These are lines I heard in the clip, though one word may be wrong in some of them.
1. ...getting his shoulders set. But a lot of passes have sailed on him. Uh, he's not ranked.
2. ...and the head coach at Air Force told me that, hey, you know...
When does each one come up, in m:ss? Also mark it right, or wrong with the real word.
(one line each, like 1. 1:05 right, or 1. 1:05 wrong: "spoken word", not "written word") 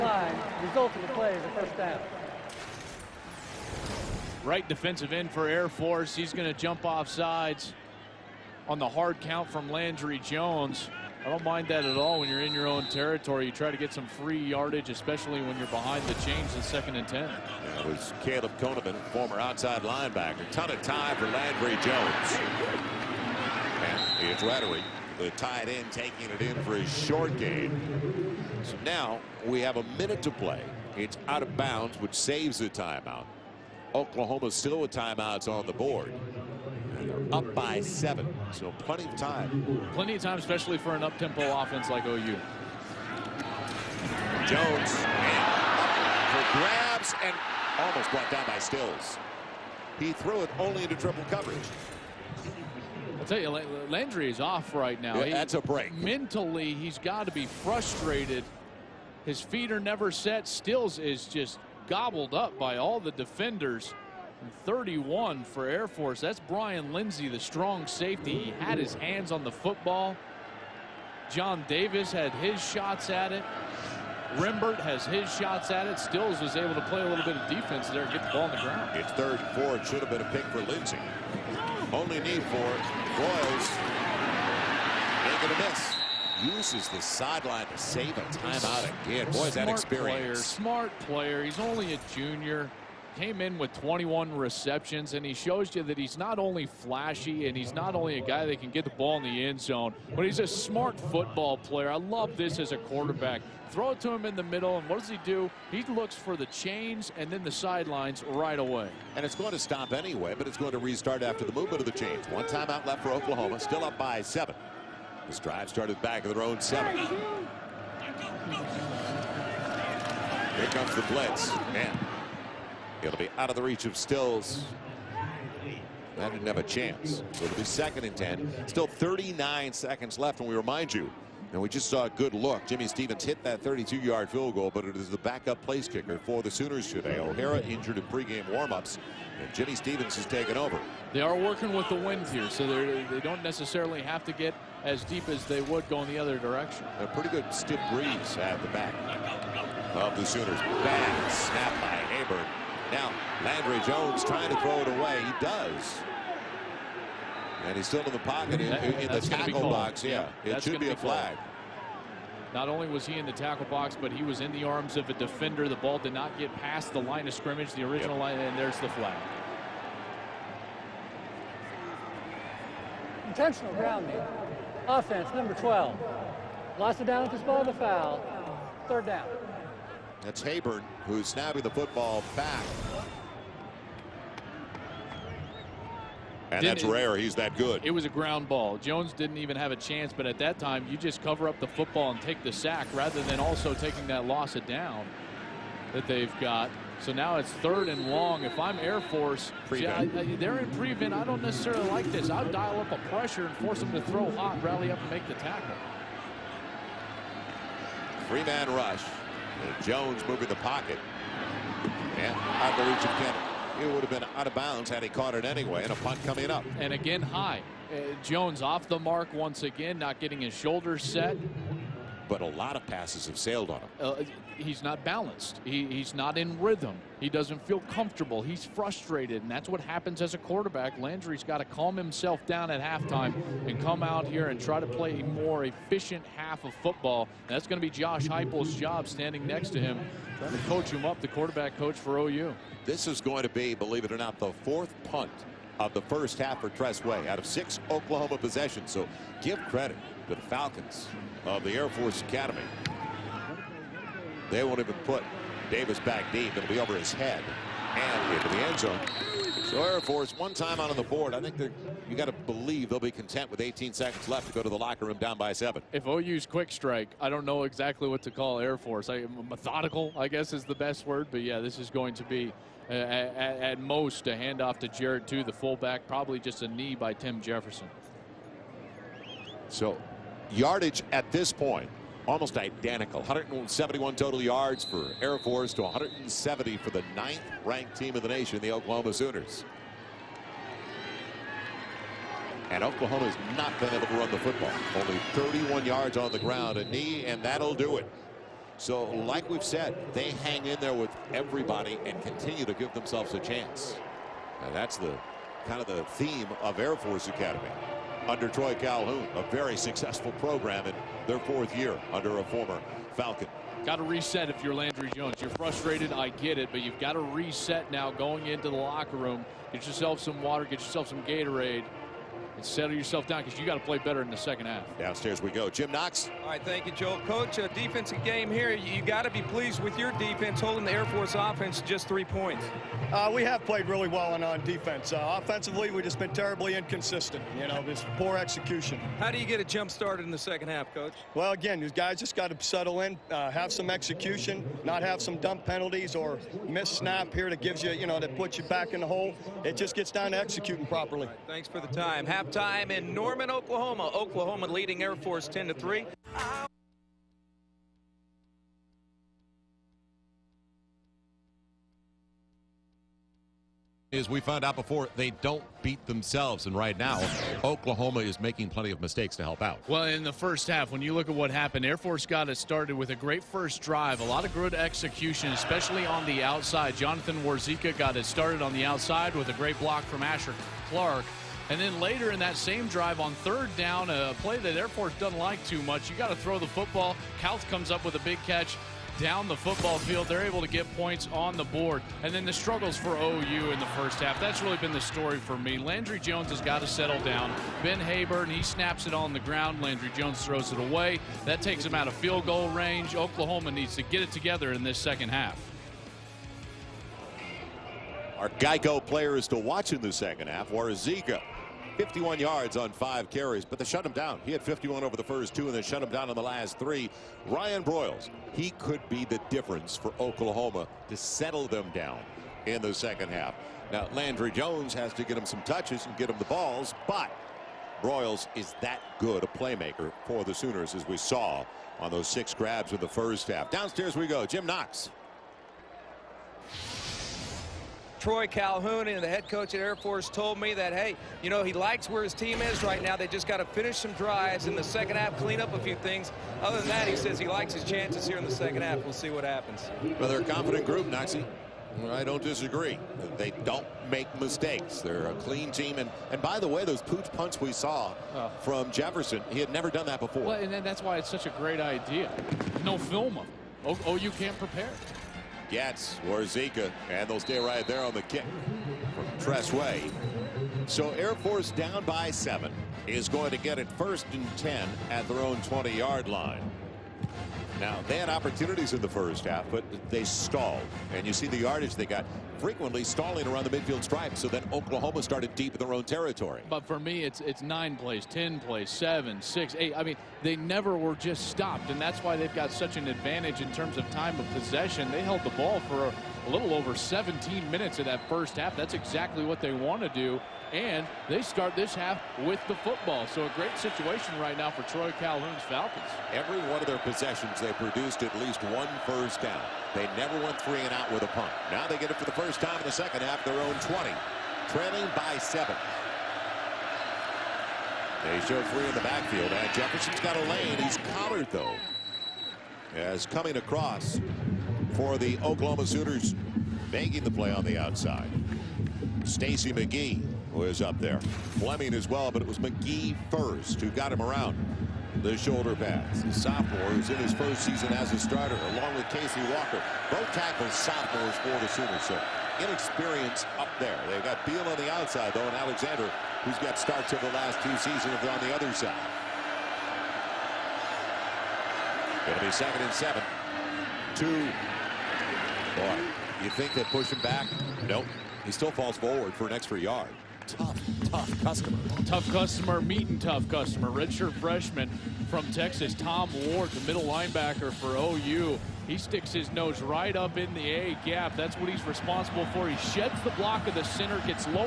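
1. 3:40 wrong: "balanced", not "ranked"
2. 7:19 right.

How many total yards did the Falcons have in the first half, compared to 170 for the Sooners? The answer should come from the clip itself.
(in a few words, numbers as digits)
171.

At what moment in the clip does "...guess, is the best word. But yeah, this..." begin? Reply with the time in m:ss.
4:30.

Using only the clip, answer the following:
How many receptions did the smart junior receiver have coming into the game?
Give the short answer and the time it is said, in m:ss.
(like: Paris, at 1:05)
21, at 1:33.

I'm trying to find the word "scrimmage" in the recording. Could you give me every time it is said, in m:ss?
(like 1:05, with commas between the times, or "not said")
2:47.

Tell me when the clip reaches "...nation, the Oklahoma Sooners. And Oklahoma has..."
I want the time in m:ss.
4:48.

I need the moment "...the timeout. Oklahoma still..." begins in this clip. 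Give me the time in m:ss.
0:32.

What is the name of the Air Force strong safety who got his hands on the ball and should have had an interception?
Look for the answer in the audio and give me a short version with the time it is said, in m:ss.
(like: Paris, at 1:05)
Brian Lindsey, at 1:06.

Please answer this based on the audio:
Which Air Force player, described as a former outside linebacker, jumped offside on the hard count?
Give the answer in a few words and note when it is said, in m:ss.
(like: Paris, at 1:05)
Caleb Conovan, at 0:18.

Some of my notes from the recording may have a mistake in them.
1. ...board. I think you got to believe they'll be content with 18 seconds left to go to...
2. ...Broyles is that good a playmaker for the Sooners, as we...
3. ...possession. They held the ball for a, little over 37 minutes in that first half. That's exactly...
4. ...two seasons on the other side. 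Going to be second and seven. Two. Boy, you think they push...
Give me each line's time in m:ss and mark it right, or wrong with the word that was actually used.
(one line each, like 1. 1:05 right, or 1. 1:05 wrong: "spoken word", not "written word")
1. 4:21 right
2. 7:08 right
3. 8:14 wrong: "17", not "37"
4. 9:07 right.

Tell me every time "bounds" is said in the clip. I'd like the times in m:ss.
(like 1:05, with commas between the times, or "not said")
0:31, 3:34.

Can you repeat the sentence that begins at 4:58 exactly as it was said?
So, like we've said, they hang in there with everybody and continue to give themselves a chance.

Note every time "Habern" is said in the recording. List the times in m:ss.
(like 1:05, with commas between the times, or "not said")
2:32, 3:00, 6:37.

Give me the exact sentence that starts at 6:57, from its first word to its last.
Ryan Broyles, he could be the difference for Oklahoma to settle them down in the second half.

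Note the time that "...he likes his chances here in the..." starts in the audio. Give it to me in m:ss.
7:27.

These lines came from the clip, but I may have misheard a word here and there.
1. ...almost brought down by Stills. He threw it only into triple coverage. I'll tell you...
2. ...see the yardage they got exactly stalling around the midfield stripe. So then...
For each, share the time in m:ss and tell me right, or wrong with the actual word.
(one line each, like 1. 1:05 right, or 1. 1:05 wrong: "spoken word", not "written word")
1. 0:47 right
2. 8:01 wrong: "frequently", not "exactly".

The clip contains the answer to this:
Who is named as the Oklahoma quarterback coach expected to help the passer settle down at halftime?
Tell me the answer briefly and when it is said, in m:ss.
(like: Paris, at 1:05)
Josh Heupel, at 3:57.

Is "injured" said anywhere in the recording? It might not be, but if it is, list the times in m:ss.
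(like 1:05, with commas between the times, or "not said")
2:17.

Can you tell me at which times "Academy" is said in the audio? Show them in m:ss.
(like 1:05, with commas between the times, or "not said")
4:12, 5:07.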